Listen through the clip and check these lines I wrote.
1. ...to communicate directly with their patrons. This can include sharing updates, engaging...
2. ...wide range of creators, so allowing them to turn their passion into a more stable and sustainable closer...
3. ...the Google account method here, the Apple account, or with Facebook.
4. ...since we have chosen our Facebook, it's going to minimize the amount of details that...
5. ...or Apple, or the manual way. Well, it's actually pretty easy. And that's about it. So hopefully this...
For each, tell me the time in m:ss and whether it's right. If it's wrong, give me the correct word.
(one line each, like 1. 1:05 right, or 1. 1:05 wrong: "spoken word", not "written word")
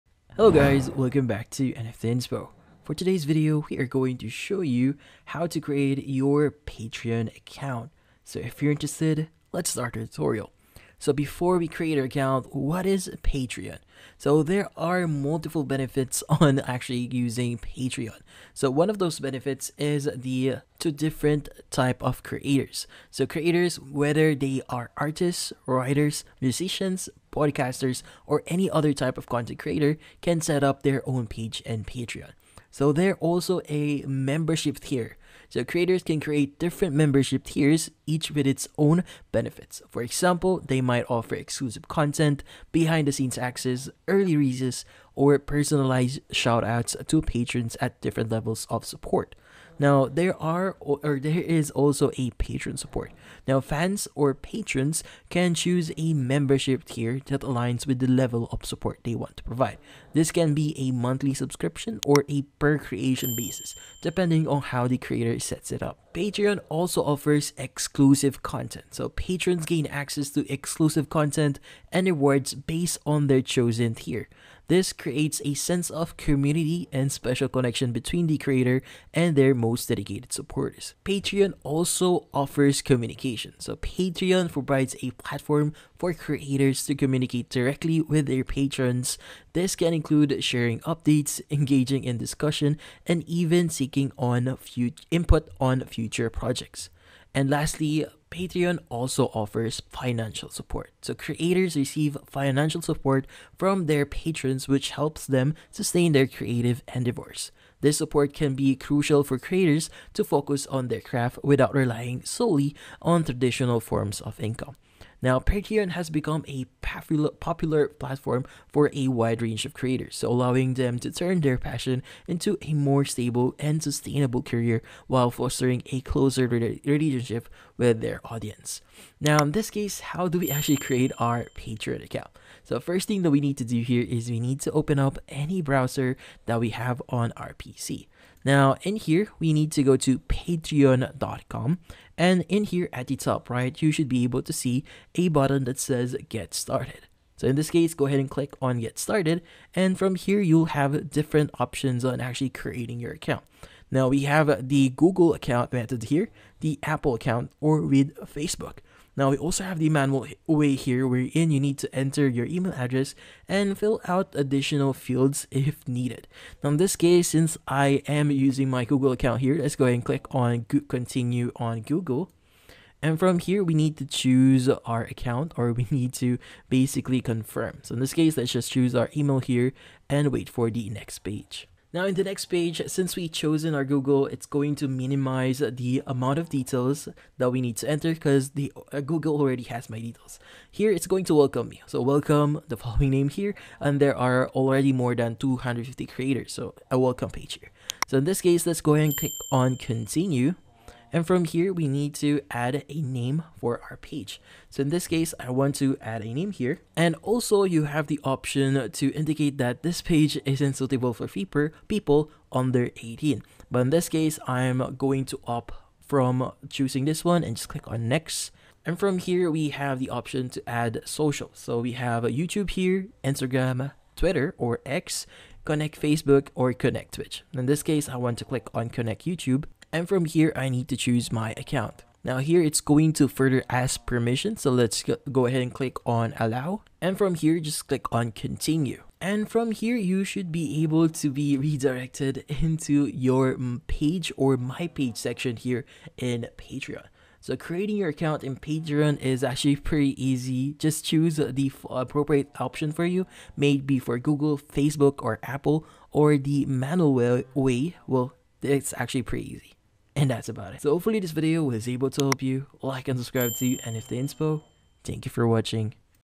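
1. 1:26 right
2. 1:59 wrong: "career", not "closer"
3. 2:34 right
4. 3:02 wrong: "Google", not "Facebook"
5. 4:15 right.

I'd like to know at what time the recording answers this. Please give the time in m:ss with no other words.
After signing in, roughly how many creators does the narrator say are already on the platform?
3:14.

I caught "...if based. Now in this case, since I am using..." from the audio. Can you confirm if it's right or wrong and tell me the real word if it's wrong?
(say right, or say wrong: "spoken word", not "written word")
wrong: "needed", not "based".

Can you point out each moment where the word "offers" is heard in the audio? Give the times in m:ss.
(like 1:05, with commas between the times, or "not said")
0:41, 1:07, 1:22, 1:39.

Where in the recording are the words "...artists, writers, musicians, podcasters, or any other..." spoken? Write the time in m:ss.
0:24.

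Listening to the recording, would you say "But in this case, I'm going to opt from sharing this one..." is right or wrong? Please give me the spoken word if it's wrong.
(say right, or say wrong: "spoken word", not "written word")
wrong: "choosing", not "sharing".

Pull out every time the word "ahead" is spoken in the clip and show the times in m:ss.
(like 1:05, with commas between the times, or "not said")
2:28, 2:49, 3:18, 3:55.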